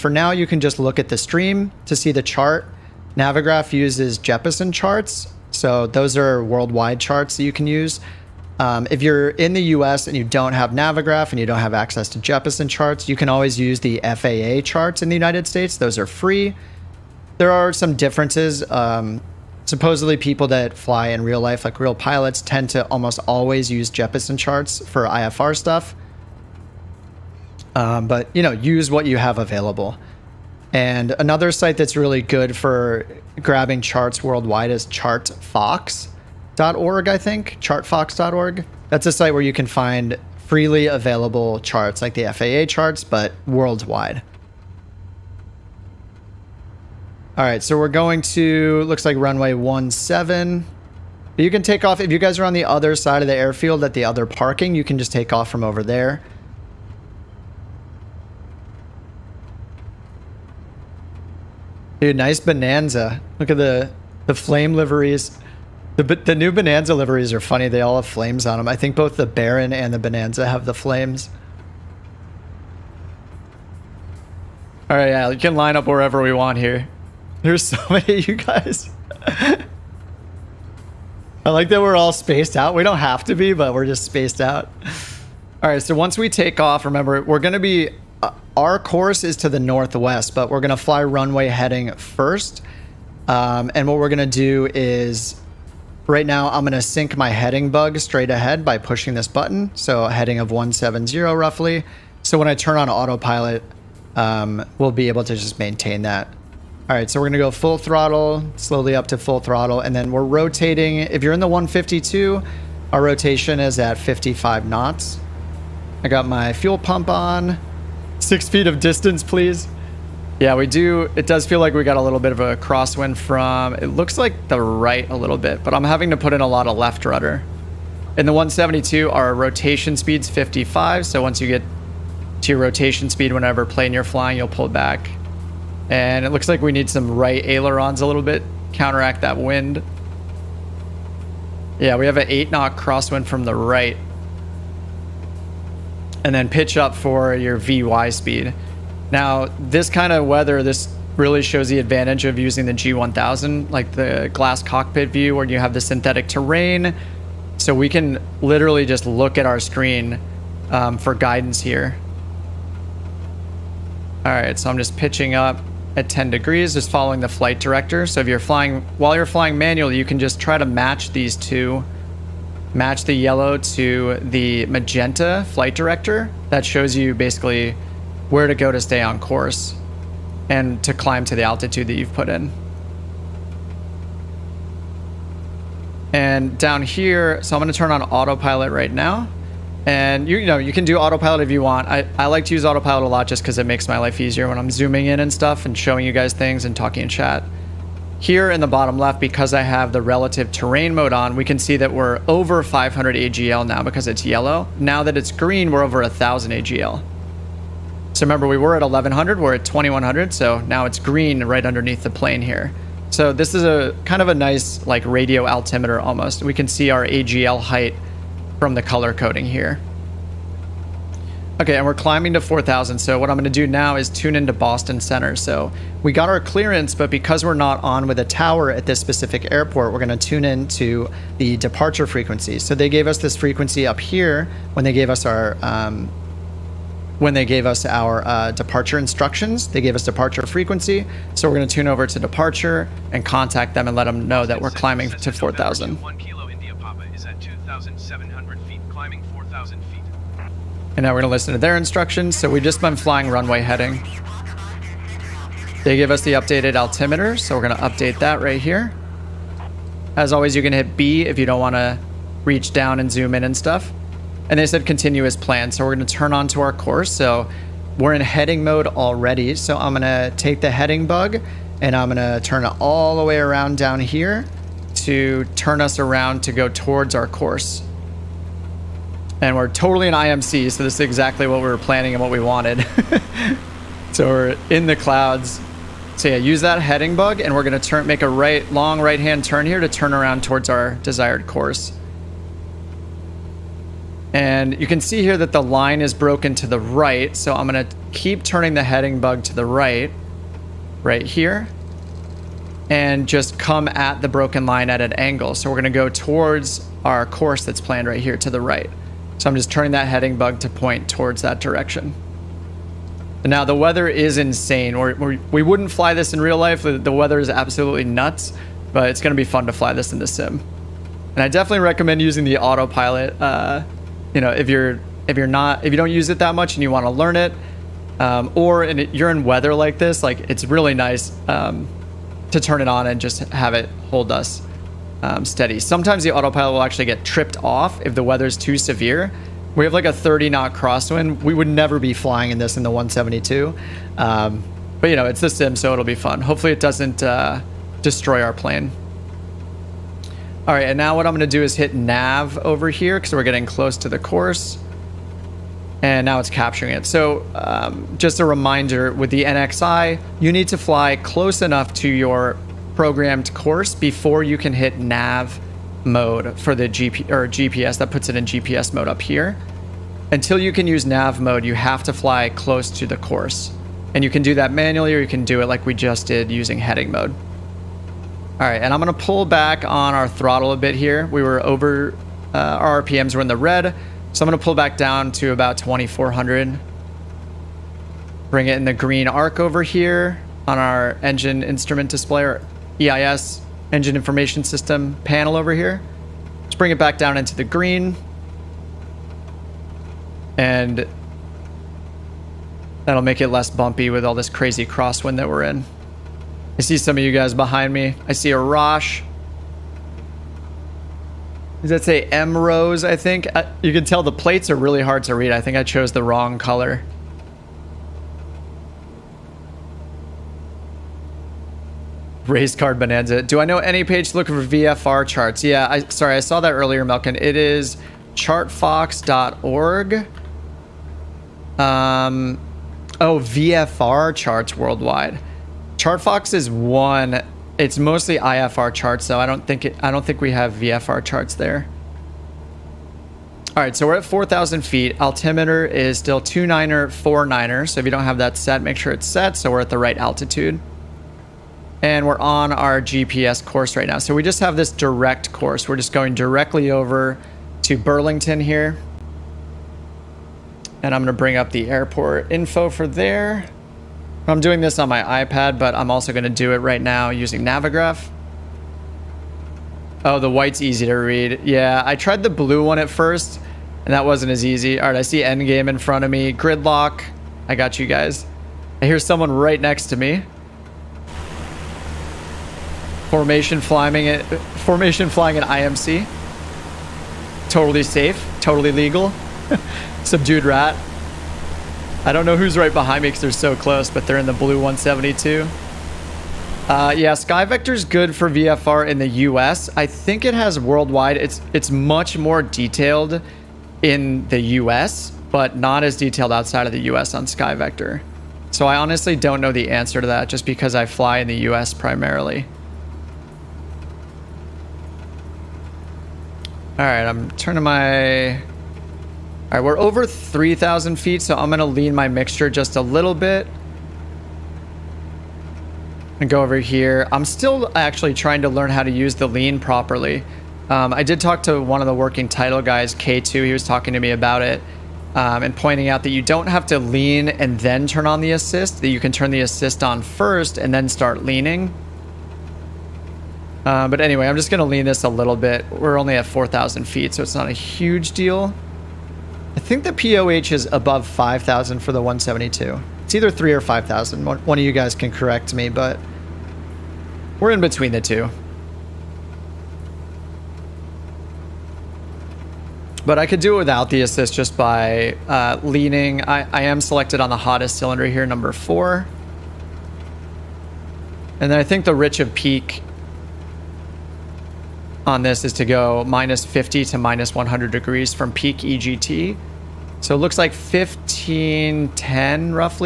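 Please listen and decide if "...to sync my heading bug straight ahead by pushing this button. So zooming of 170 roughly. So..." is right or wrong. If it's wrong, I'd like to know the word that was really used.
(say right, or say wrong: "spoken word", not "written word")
wrong: "heading", not "zooming".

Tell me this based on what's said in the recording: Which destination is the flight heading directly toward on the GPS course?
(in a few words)
Burlington.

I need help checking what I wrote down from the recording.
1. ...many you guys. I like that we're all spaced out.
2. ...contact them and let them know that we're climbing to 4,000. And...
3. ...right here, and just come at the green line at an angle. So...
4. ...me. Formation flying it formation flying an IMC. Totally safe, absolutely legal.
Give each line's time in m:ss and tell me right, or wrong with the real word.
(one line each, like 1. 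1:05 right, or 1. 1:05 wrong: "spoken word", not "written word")
1. 1:17 right
2. 4:03 right
3. 5:01 wrong: "broken", not "green"
4. 8:00 wrong: "totally", not "absolutely".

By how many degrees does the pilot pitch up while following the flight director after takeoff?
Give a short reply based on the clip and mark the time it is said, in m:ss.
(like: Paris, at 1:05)
10 degrees, at 2:46.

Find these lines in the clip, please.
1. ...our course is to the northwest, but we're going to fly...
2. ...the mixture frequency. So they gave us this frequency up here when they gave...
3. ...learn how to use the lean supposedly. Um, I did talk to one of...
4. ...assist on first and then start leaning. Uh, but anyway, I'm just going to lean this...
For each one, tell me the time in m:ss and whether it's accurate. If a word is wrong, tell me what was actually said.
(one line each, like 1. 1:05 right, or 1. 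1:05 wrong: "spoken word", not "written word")
1. 1:28 right
2. 3:51 wrong: "departure", not "mixture"
3. 8:48 wrong: "properly", not "supposedly"
4. 8:59 right.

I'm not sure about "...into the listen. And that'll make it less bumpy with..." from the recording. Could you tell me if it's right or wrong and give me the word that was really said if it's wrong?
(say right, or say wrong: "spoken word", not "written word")
wrong: "green", not "listen".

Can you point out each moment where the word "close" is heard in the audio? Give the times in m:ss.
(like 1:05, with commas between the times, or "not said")
5:53, 6:01, 6:12, 8:13.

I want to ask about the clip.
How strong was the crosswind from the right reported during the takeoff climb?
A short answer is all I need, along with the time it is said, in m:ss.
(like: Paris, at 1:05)
8 knots, at 2:22.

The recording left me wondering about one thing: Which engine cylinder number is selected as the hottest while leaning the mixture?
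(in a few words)
4.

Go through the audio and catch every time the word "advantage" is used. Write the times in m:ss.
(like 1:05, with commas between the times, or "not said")
2:31.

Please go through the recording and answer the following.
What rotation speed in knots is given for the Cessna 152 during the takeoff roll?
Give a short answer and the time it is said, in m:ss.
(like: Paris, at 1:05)
55 knots, at 1:53.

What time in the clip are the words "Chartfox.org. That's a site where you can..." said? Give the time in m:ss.
0:37.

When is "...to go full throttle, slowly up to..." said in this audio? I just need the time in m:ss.
1:47.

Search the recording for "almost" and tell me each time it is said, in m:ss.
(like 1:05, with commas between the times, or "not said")
0:22, 3:35.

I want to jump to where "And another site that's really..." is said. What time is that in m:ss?
0:30.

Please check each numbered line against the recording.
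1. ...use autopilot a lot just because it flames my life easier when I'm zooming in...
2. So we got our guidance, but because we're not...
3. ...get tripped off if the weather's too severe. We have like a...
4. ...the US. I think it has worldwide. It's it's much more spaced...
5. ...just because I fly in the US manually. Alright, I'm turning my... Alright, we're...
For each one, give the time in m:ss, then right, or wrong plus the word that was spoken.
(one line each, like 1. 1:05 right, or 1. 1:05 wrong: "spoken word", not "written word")
1. 3:12 wrong: "makes", not "flames"
2. 3:45 wrong: "clearance", not "guidance"
3. 5:37 right
4. 8:19 wrong: "detailed", not "spaced"
5. 8:30 wrong: "primarily", not "manually".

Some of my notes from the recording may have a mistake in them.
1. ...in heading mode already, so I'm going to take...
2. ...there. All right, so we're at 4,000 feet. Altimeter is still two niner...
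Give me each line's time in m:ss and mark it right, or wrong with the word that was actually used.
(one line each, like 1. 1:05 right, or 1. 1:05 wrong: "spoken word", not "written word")
1. 4:28 right
2. 7:21 right.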